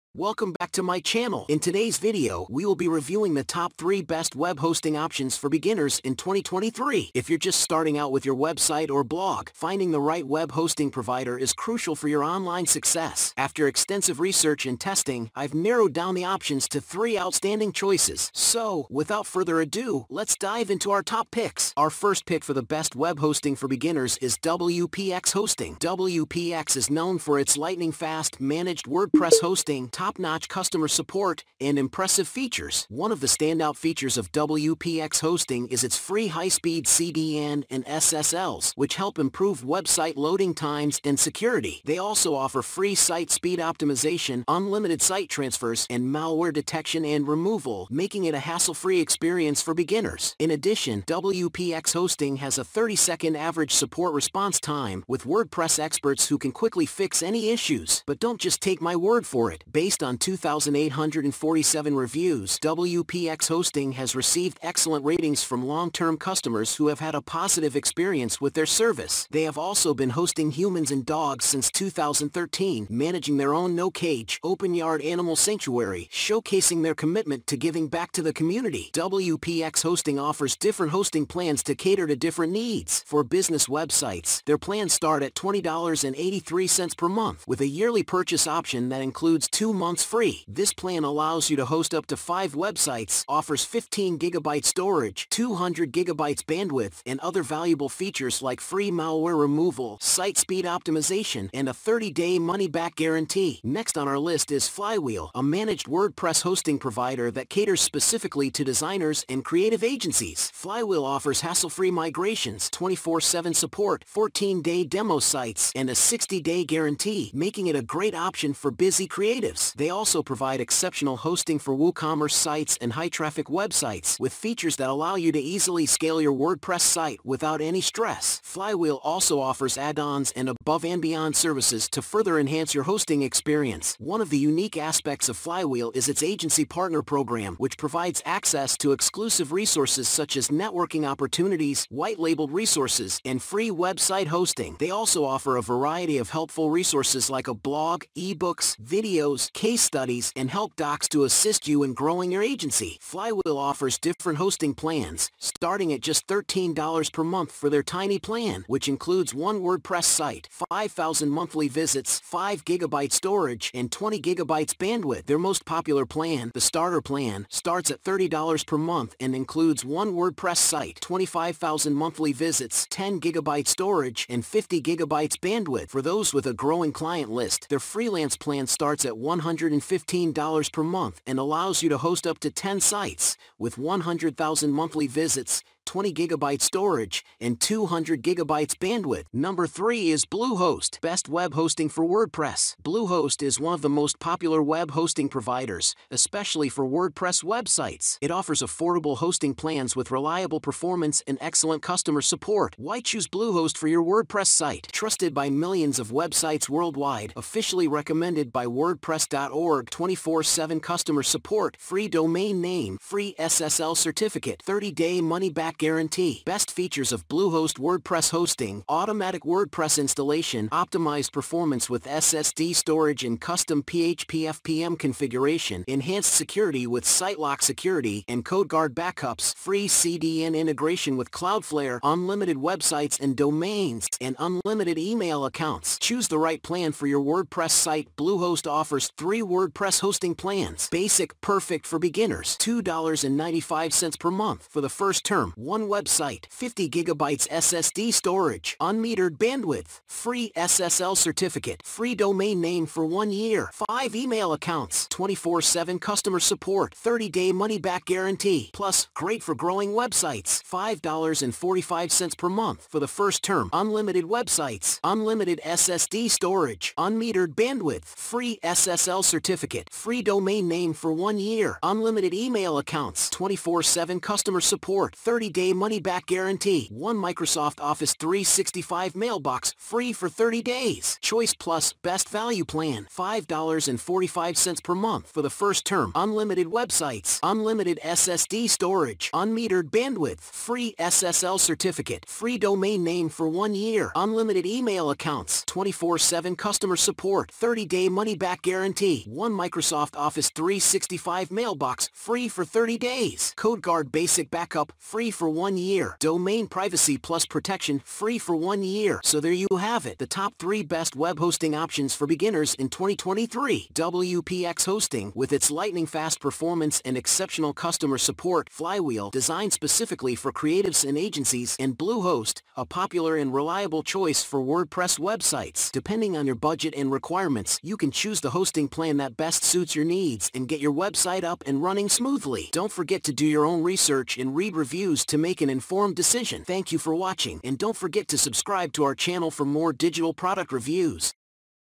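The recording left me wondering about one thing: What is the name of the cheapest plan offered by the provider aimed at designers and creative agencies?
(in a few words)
tiny plan.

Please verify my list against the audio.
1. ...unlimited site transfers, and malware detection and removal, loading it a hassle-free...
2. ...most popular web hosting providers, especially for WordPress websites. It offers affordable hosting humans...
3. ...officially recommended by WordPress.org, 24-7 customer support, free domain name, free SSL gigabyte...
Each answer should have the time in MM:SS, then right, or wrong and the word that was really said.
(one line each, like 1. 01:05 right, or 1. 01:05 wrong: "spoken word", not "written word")
1. 00:44 wrong: "making", not "loading"
2. 03:13 wrong: "plans", not "humans"
3. 03:27 wrong: "certificate", not "gigabyte".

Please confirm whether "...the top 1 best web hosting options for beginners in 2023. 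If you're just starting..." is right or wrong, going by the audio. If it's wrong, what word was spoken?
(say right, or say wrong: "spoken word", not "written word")
wrong: "3", not "1".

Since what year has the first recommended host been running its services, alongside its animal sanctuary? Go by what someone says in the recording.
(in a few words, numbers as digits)
2013.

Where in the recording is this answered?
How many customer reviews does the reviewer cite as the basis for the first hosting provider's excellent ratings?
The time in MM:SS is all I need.
01:00.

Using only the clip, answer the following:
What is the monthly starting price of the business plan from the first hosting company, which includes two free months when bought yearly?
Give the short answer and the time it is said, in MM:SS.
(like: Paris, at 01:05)
$20.83, at 01:25.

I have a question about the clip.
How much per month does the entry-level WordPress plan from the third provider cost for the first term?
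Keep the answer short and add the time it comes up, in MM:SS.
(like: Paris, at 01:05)
$2.95, at 04:02.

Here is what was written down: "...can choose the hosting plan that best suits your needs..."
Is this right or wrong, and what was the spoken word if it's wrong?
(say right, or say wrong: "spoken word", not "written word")
right.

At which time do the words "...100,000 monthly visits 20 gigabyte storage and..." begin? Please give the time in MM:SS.
03:03.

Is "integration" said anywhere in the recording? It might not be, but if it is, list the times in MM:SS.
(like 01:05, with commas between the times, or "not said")
03:50.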